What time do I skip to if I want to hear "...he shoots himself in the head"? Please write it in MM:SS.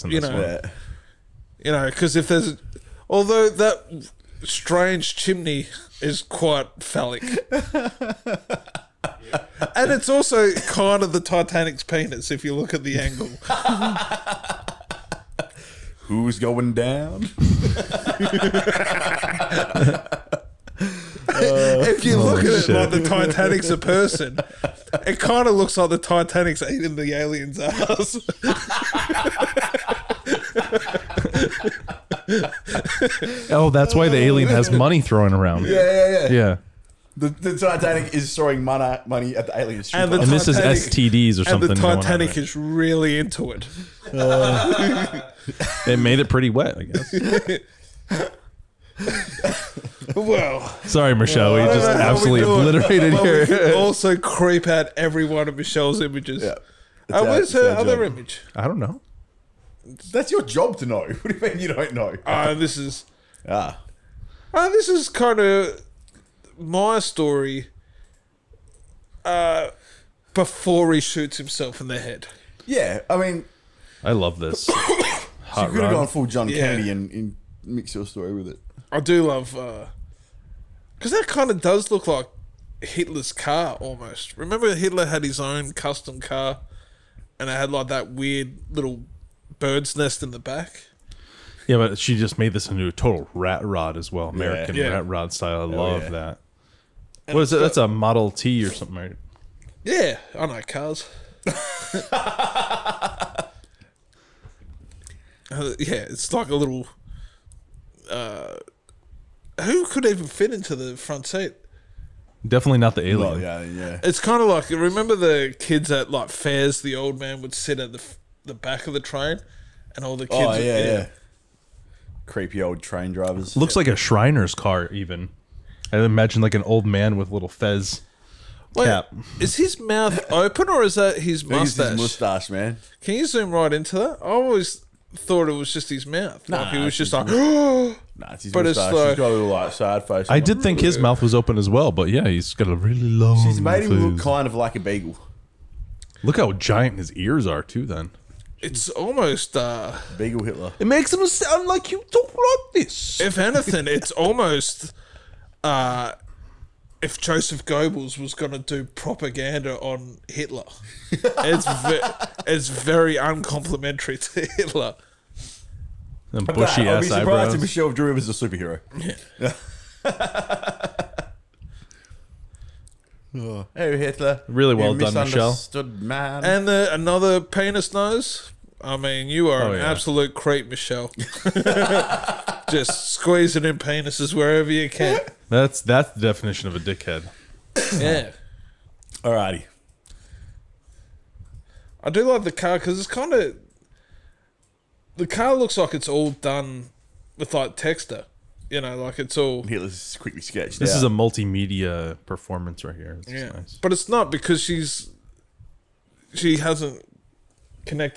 01:10.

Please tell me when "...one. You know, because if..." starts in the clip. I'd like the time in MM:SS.
00:00.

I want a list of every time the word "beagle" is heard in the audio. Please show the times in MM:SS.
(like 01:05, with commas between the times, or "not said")
02:24, 02:30.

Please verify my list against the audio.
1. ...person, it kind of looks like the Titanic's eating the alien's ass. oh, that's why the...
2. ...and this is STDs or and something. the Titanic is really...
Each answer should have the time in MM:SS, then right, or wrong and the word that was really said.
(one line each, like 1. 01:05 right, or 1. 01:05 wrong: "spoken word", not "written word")
1. 00:23 right
2. 00:40 right.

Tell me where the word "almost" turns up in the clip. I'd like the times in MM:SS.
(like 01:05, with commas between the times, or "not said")
01:23, 02:28, 02:34.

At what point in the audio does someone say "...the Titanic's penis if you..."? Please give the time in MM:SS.
00:11.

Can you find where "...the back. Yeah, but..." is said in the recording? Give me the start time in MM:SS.
01:30.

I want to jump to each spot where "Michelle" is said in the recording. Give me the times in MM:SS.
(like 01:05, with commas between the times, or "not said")
00:51, 00:55, 02:47, 02:55, 03:00.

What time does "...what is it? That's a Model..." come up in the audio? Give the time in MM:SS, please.
01:37.